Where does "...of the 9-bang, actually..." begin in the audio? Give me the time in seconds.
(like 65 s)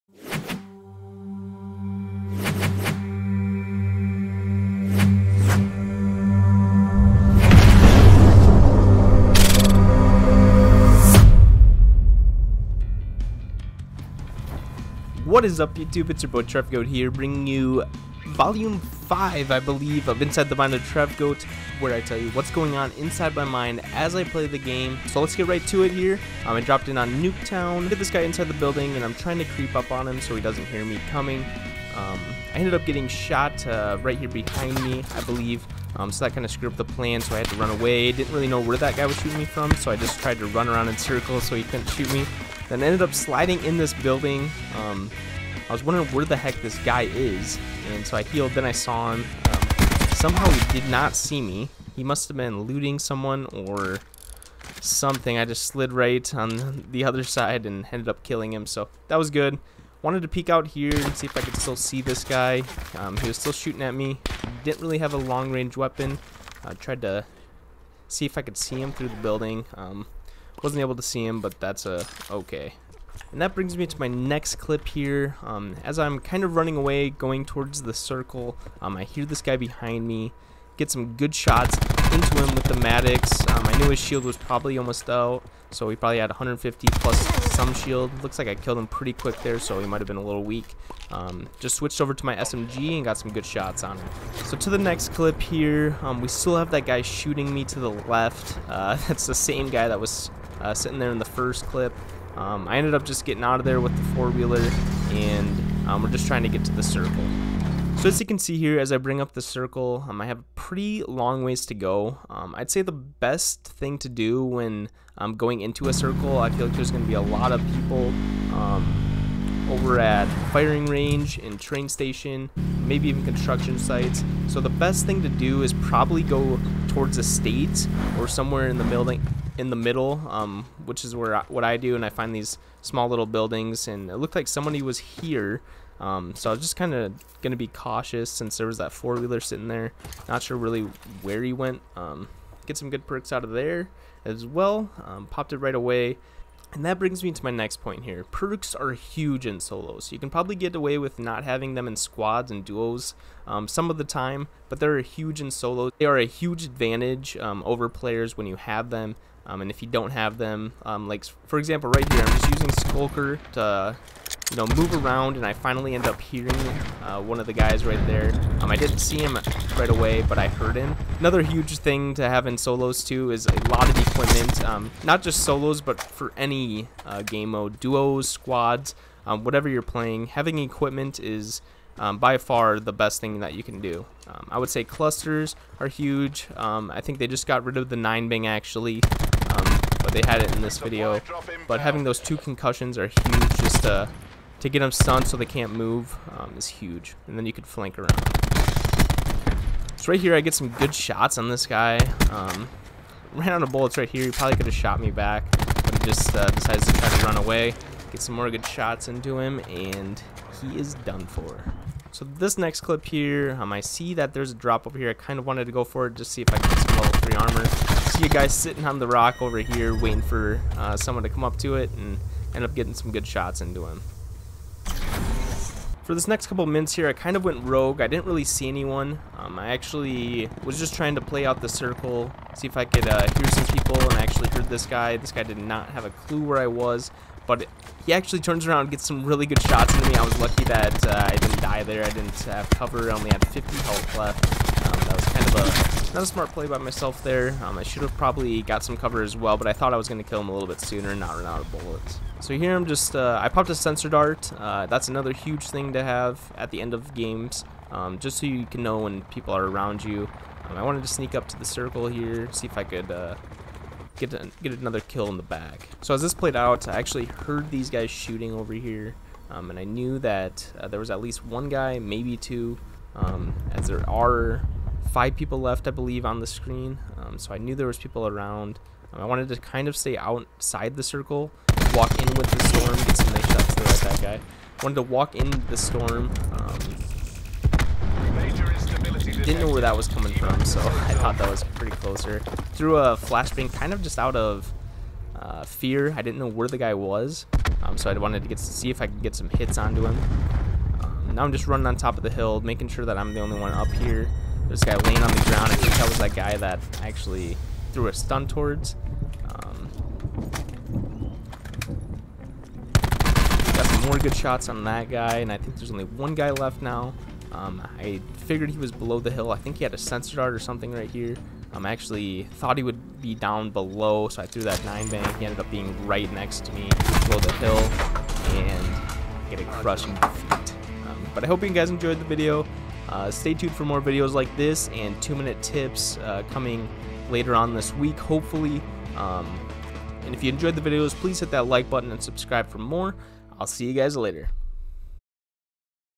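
187 s.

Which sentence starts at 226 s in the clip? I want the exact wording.
For this next couple mints here, I kind of went rogue.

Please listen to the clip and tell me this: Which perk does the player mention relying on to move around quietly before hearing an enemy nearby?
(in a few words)
Skulker.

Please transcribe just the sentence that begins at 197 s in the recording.
And then you could flank around.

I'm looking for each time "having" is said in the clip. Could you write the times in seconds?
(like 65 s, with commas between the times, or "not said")
151 s, 180 s, 191 s.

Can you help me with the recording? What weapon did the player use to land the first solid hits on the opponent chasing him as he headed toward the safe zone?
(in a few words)
Maddox.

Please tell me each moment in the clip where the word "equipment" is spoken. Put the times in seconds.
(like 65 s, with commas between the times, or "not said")
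174 s, 180 s.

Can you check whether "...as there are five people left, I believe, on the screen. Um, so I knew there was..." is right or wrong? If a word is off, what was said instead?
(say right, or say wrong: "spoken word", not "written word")
right.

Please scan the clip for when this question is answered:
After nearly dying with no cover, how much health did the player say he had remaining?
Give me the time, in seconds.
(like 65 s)
243 s.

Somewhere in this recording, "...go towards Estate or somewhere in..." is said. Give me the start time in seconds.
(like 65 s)
126 s.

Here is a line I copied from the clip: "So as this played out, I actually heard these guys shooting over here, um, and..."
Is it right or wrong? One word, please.
right.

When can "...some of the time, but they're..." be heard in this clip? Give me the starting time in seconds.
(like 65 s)
153 s.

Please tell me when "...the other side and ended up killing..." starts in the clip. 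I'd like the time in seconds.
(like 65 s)
56 s.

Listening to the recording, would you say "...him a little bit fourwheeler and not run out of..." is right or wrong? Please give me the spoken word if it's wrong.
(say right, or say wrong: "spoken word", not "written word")
wrong: "sooner", not "fourwheeler".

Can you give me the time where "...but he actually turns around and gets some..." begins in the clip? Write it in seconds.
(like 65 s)
237 s.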